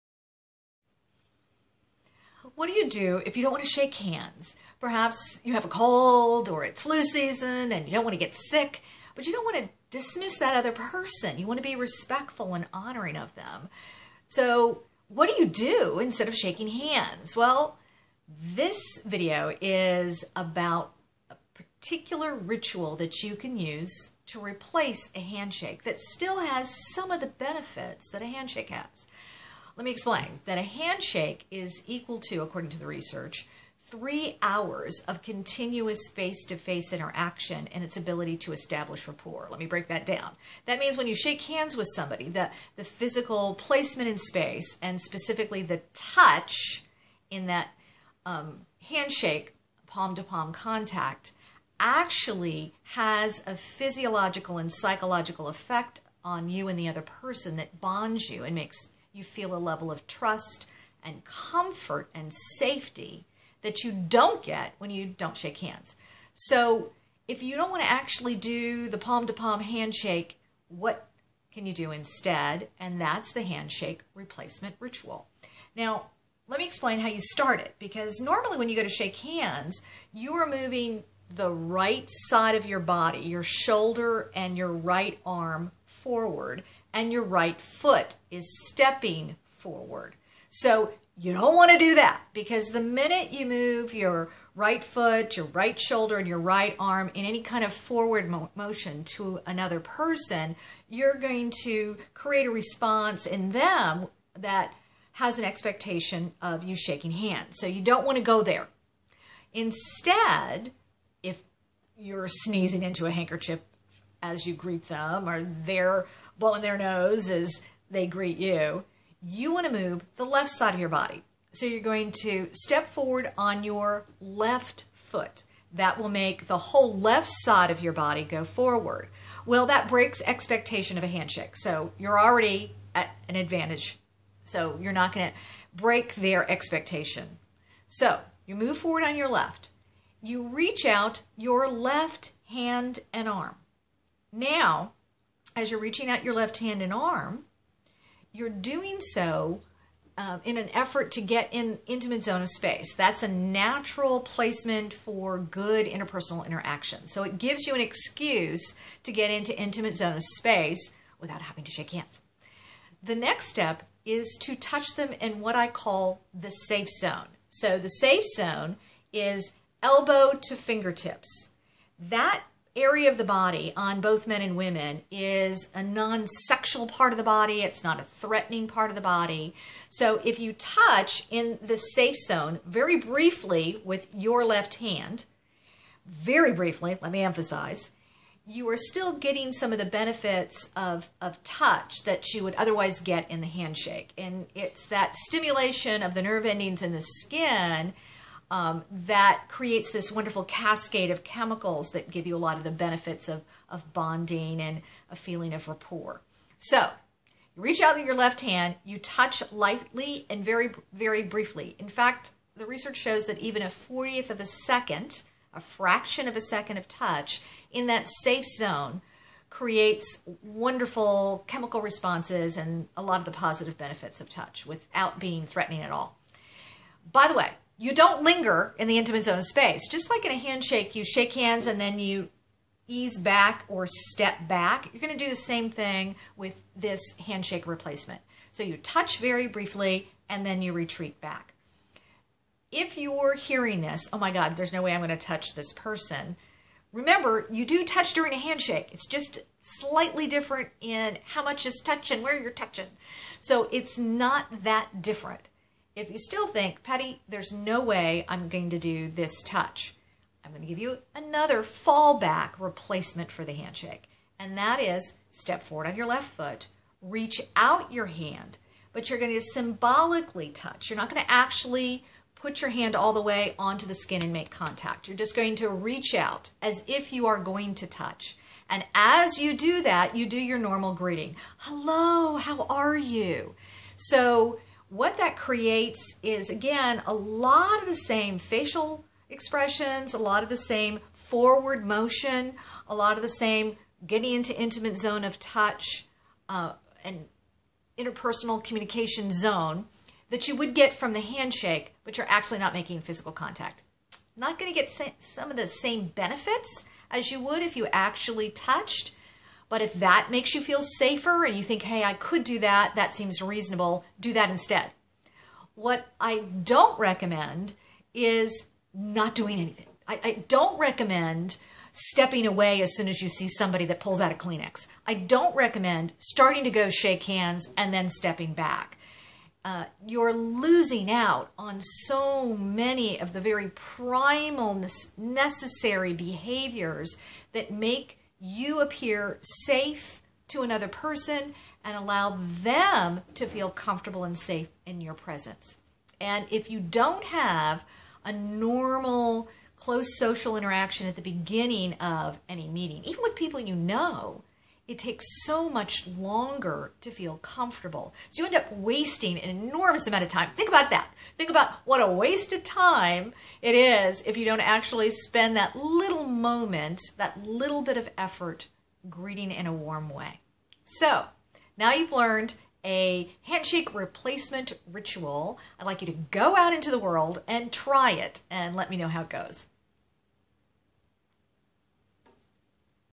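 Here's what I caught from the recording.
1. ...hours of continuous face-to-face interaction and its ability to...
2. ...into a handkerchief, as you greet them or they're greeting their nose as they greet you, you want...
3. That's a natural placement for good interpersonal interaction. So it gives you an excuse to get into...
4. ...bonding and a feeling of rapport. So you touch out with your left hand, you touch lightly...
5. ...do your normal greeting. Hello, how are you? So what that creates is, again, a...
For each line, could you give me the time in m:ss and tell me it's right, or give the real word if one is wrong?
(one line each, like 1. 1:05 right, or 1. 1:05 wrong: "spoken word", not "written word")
1. 0:34 right
2. 1:52 wrong: "blowing", not "greeting"
3. 2:32 right
4. 3:23 wrong: "reach", not "touch"
5. 4:40 right.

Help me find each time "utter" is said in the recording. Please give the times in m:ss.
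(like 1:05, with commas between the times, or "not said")
not said.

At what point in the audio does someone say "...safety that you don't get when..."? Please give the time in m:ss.
1:02.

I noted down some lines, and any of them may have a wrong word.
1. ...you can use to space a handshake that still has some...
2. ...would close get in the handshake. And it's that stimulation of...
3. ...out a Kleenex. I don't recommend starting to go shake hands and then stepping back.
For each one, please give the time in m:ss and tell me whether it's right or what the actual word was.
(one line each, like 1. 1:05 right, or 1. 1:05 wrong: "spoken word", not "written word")
1. 0:23 wrong: "replace", not "space"
2. 3:12 wrong: "otherwise", not "close"
3. 5:24 right.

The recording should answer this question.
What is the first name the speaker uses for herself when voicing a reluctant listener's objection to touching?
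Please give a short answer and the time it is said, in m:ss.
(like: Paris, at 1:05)
Patti, at 4:16.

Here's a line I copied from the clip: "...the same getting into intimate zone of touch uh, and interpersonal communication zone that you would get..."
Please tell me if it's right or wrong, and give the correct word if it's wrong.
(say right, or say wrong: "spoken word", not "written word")
right.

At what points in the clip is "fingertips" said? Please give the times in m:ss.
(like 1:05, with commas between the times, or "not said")
2:50.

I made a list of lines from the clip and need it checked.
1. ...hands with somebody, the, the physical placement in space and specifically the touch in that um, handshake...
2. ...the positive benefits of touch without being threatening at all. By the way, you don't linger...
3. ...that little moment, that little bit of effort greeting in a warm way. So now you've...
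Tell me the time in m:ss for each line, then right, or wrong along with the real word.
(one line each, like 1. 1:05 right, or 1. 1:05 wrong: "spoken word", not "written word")
1. 0:41 right
2. 3:43 right
3. 6:05 right.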